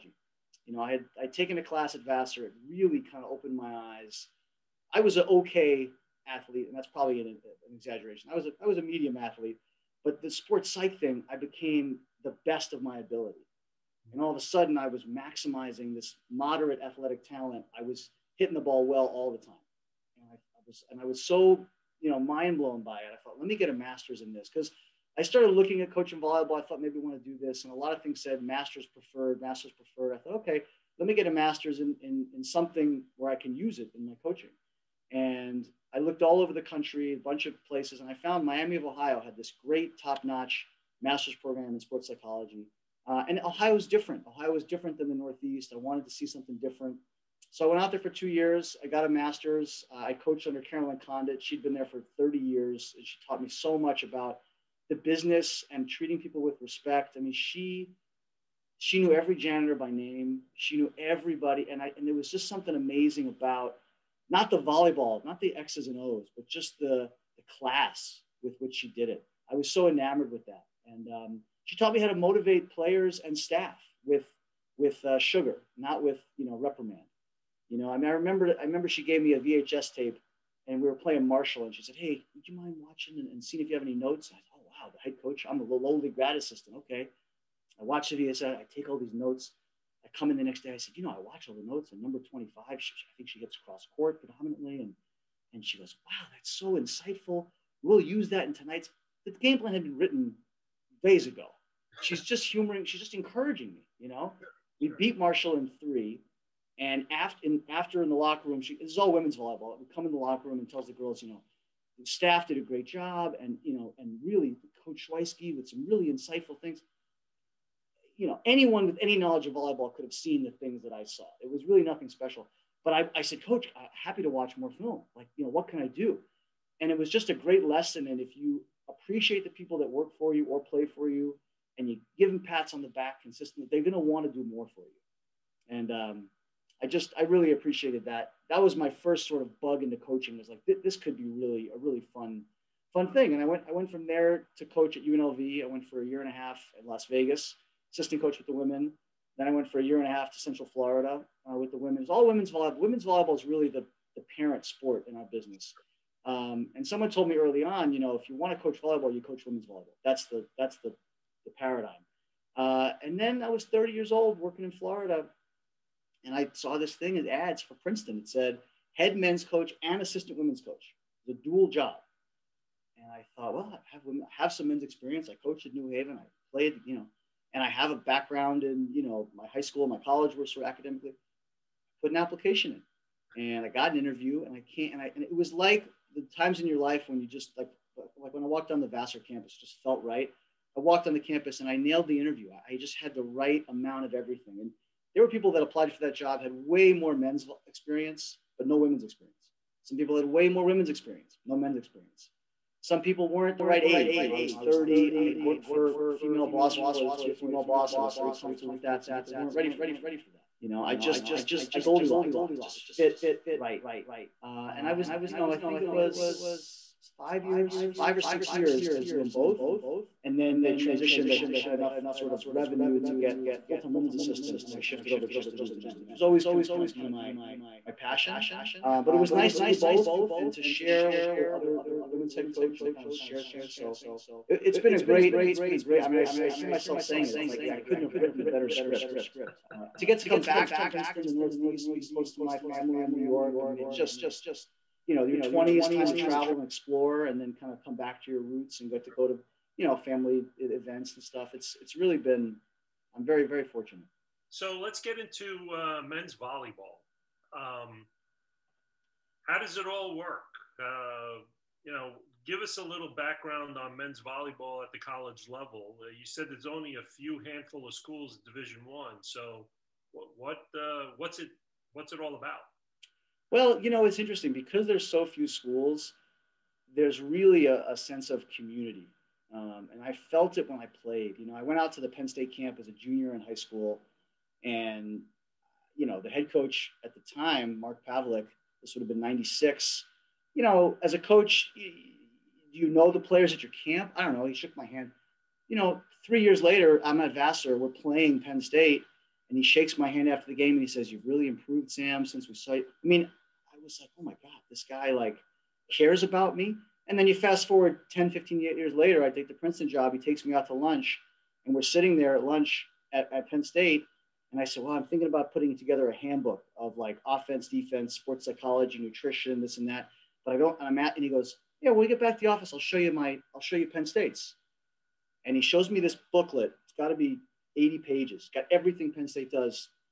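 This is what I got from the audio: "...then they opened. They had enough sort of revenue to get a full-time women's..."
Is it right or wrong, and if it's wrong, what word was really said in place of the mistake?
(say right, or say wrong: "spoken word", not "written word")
wrong: "transitioned", not "opened".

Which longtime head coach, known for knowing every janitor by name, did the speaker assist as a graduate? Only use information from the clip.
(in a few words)
Carolyn Condit.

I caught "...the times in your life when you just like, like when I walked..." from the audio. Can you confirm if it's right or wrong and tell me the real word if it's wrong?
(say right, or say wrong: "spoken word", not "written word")
right.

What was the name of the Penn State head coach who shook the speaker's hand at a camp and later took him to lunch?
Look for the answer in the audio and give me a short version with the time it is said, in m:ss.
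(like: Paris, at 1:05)
Mark Pavlik, at 4:47.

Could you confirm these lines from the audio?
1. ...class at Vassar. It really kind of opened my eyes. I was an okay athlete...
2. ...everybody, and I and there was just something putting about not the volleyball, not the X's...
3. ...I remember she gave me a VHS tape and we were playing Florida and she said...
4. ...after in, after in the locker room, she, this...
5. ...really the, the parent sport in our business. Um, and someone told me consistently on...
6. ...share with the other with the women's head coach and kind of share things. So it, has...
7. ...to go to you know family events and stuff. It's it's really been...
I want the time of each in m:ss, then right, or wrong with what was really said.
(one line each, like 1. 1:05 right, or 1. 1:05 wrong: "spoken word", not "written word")
1. 0:01 right
2. 1:00 wrong: "amazing", not "putting"
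3. 1:18 wrong: "Marshall", not "Florida"
4. 1:47 right
5. 2:33 wrong: "early", not "consistently"
6. 3:50 right
7. 4:09 right.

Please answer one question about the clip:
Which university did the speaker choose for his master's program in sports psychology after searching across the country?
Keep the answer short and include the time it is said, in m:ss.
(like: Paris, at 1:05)
Miami of Ohio, at 0:38.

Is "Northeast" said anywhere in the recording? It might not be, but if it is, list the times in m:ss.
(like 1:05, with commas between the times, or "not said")
0:45, 4:01.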